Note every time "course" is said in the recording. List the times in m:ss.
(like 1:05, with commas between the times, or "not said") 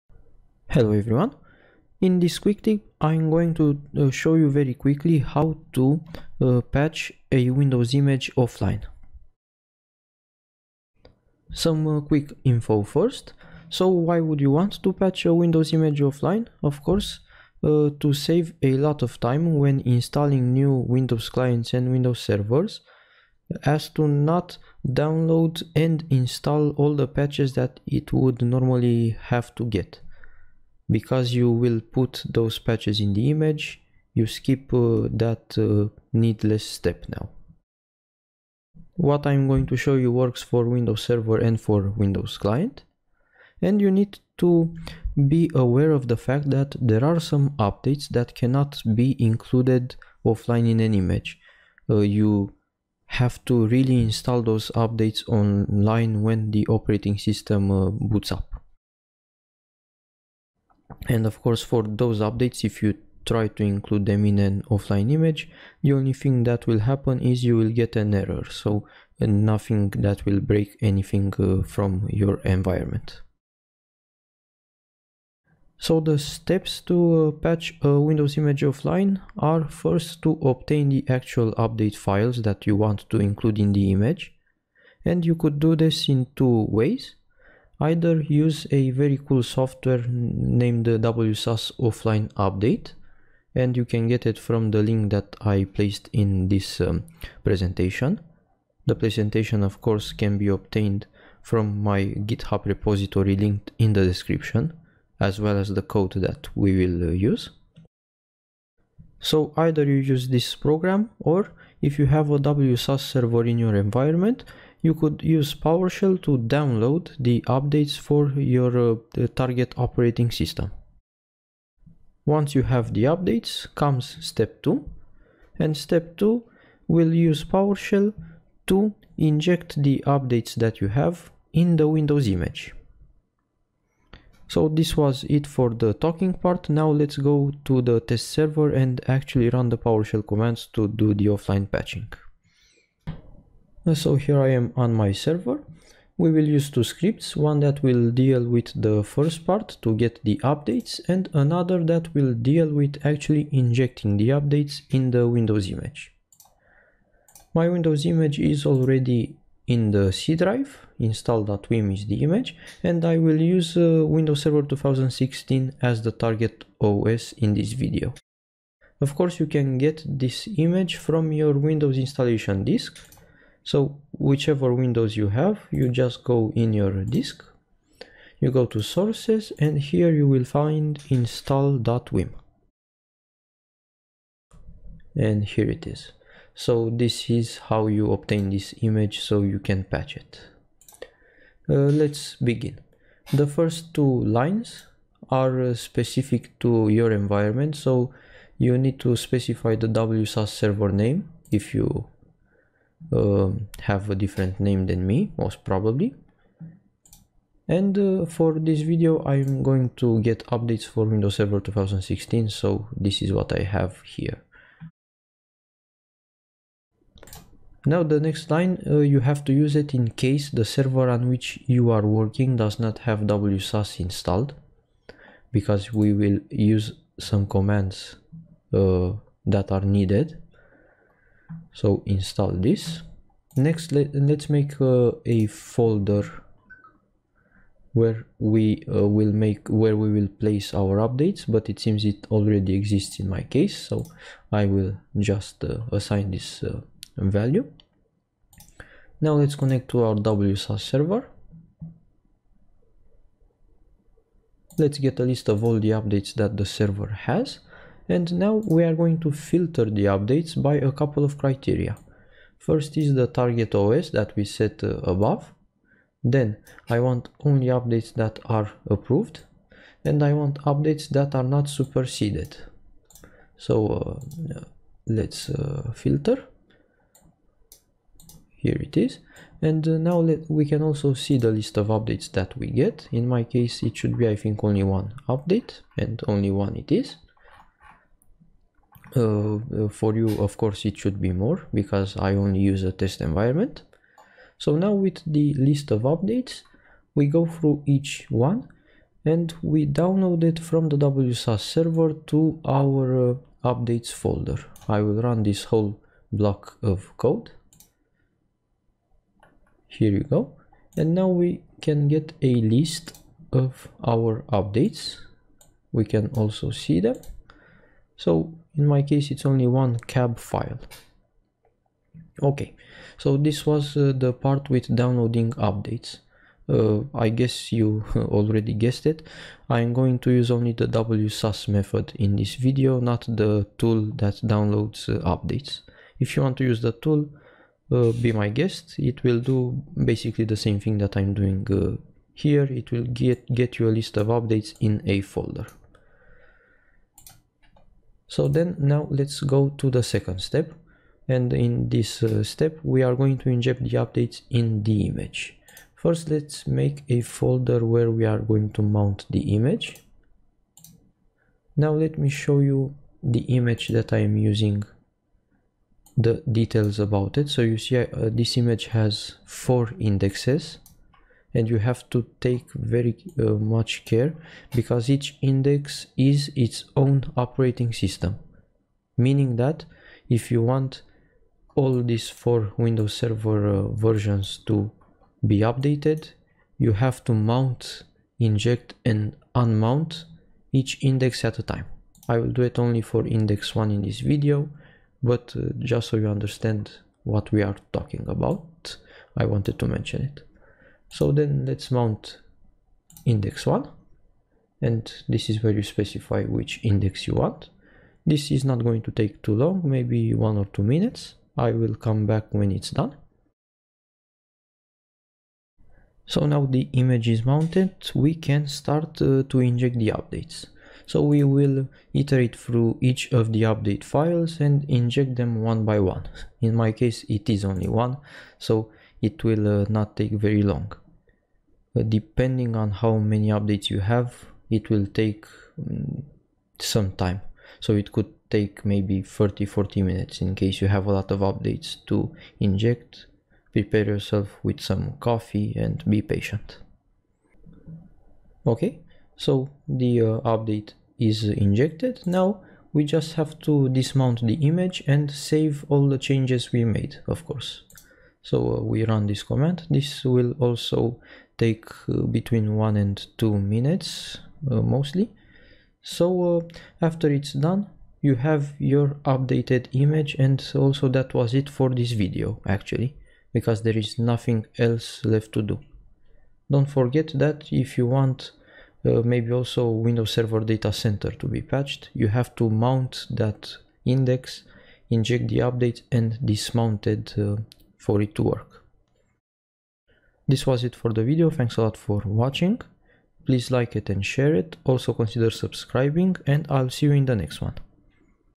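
0:16, 1:01, 1:39, 2:49, 4:50, 7:37.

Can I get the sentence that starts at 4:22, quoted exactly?
First is the target OS that we set uh, above.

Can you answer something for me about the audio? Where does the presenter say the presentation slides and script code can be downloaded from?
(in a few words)
GitHub repository.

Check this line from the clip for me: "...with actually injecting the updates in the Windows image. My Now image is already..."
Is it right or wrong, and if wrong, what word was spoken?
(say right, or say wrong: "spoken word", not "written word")
wrong: "Windows", not "Now".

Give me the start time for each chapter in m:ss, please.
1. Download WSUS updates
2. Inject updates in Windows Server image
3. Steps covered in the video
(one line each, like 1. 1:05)
1. 2:24
2. 5:49
3. 1:15.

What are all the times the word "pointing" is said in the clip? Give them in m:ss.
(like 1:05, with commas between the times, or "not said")
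not said.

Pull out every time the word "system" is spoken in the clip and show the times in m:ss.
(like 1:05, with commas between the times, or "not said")
0:57, 2:00, 6:17.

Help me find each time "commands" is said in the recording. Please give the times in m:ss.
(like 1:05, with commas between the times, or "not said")
2:20, 3:47, 7:39.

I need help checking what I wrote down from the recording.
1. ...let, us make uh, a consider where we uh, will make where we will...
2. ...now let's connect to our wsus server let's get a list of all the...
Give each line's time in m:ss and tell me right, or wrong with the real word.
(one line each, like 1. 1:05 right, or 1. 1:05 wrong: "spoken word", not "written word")
1. 3:53 wrong: "folder", not "consider"
2. 4:09 right.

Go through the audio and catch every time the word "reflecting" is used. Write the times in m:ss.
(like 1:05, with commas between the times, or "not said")
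not said.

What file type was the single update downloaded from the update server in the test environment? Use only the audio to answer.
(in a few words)
cab file.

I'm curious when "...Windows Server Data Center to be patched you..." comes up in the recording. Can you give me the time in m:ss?
8:00.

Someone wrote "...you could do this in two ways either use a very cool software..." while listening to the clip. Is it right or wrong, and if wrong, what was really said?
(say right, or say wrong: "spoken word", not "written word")
right.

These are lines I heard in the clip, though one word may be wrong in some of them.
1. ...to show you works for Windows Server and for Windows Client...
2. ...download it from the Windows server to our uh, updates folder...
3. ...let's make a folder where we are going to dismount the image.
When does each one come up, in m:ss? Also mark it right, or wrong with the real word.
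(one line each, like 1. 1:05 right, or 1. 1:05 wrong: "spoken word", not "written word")
1. 0:39 right
2. 4:59 wrong: "WSUS", not "Windows"
3. 5:56 wrong: "mount", not "dismount".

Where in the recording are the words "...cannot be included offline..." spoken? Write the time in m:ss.
0:48.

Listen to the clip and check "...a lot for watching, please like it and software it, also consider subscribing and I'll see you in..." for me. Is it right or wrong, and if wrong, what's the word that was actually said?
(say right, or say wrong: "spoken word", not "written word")
wrong: "share", not "software".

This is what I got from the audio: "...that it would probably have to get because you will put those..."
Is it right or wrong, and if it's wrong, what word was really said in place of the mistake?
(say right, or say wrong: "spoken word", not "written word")
wrong: "normally", not "probably".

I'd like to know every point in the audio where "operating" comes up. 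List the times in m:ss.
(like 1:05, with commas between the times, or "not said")
0:56, 1:59, 6:17.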